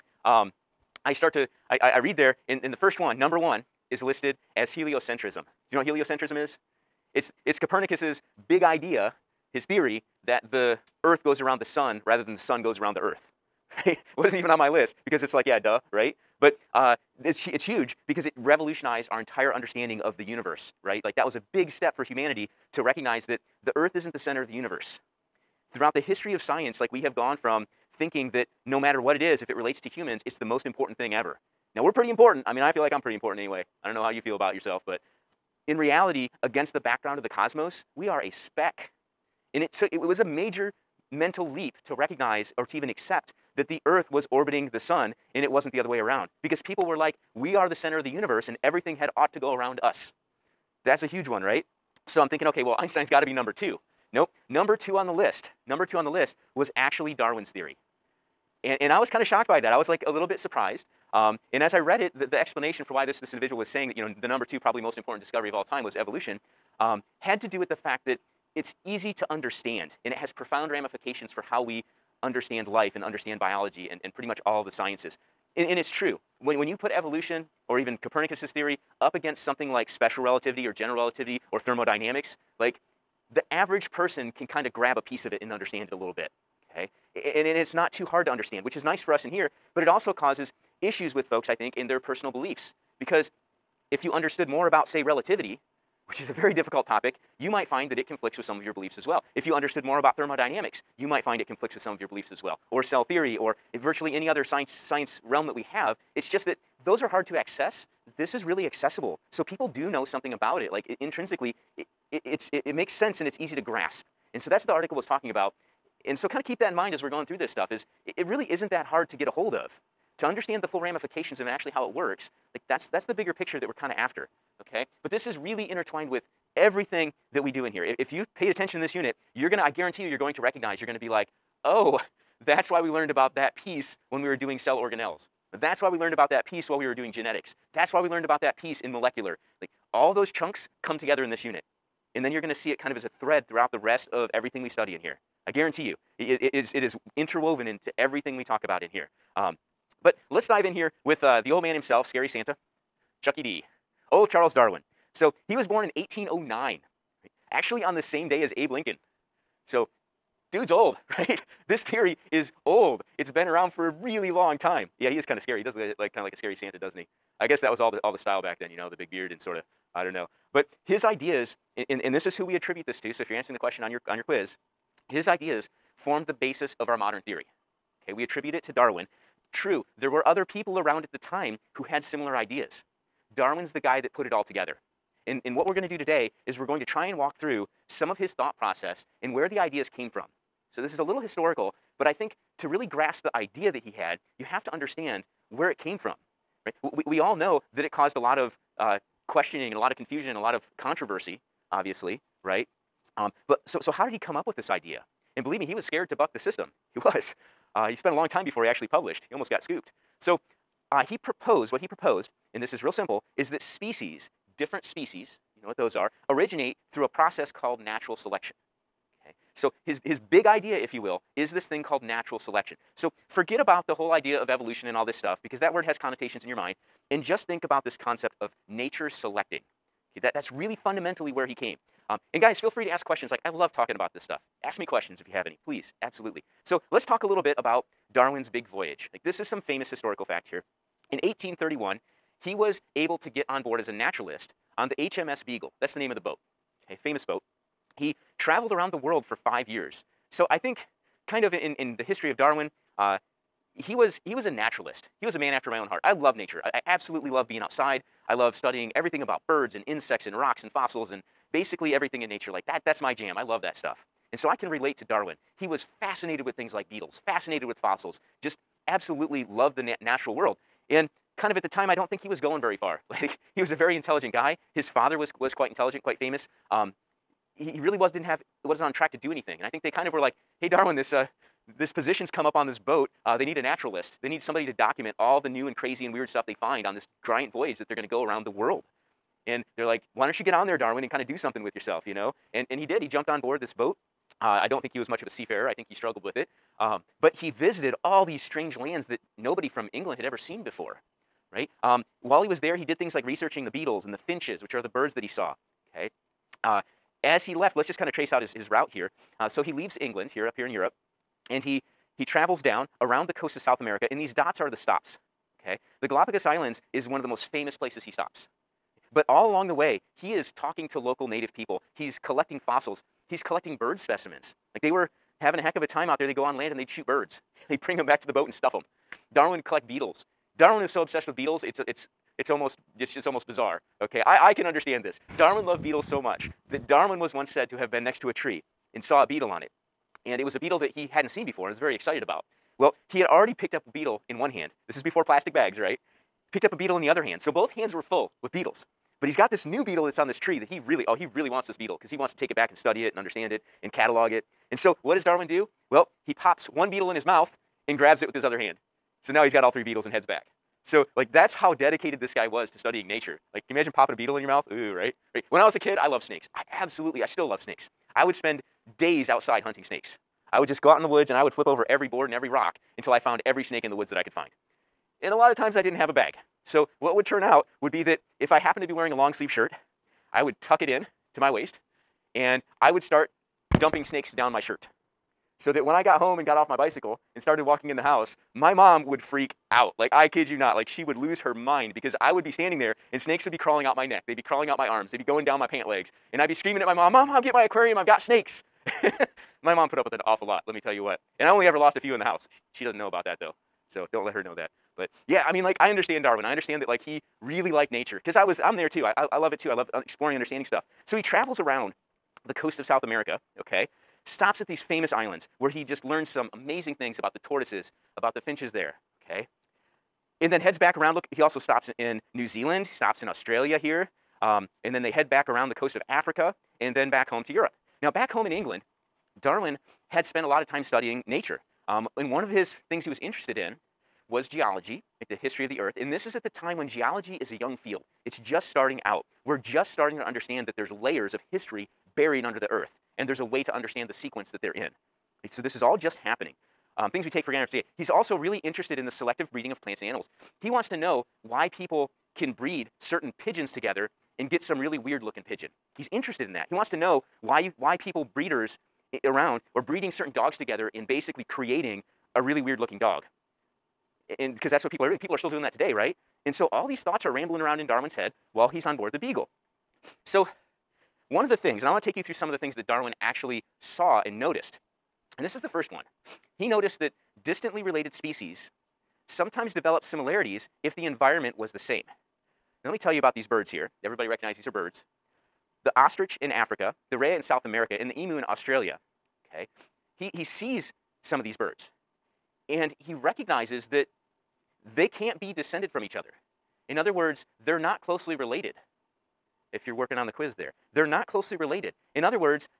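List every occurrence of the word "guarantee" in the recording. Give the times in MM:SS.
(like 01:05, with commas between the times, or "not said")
02:09, 02:25.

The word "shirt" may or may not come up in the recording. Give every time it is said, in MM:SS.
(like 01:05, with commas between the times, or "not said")
06:19, 06:24.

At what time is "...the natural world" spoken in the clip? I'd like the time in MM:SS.
04:29.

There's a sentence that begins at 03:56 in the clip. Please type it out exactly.
So let's talk a little bit about Darwin's big voyage.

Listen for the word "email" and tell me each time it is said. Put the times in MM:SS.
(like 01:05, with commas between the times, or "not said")
not said.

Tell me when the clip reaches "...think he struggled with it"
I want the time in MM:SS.
04:55.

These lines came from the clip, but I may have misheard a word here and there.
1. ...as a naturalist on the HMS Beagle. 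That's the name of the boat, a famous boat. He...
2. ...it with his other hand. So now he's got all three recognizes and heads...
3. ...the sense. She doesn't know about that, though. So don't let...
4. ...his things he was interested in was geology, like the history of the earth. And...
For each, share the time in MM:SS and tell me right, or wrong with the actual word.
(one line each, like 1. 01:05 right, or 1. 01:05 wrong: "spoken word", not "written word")
1. 04:03 right
2. 05:58 wrong: "beetles", not "recognizes"
3. 06:42 wrong: "house", not "sense"
4. 07:12 right.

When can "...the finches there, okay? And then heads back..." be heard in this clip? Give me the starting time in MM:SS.
06:58.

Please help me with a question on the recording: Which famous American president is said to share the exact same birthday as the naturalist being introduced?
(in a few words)
Abe Lincoln.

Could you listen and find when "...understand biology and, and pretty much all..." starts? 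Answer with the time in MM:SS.
01:13.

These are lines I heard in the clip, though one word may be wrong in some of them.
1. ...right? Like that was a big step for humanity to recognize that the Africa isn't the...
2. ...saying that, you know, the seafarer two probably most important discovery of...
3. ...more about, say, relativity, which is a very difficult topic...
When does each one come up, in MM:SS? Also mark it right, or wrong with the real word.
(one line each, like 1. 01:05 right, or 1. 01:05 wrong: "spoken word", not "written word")
1. 00:20 wrong: "Earth", not "Africa"
2. 01:03 wrong: "number", not "seafarer"
3. 01:34 right.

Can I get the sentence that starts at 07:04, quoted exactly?
Um, and then they head back around the coast of Africa and then back home to Europe.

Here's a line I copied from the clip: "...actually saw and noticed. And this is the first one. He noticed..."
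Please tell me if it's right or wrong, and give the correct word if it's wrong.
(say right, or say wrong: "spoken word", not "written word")
right.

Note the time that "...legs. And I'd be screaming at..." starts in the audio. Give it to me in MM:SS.
06:35.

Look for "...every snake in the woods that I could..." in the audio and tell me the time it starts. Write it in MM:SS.
06:13.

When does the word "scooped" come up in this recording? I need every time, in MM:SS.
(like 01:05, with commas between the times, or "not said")
03:29.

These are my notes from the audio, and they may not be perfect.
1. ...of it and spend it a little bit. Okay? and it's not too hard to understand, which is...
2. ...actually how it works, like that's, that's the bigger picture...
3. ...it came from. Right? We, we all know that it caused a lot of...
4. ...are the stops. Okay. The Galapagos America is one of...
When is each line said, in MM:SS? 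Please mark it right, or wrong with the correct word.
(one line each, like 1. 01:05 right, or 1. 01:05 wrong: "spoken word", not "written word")
1. 01:25 wrong: "understand", not "spend"
2. 02:01 right
3. 03:15 right
4. 05:14 wrong: "Islands", not "America".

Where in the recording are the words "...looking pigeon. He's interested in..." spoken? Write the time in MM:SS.
07:35.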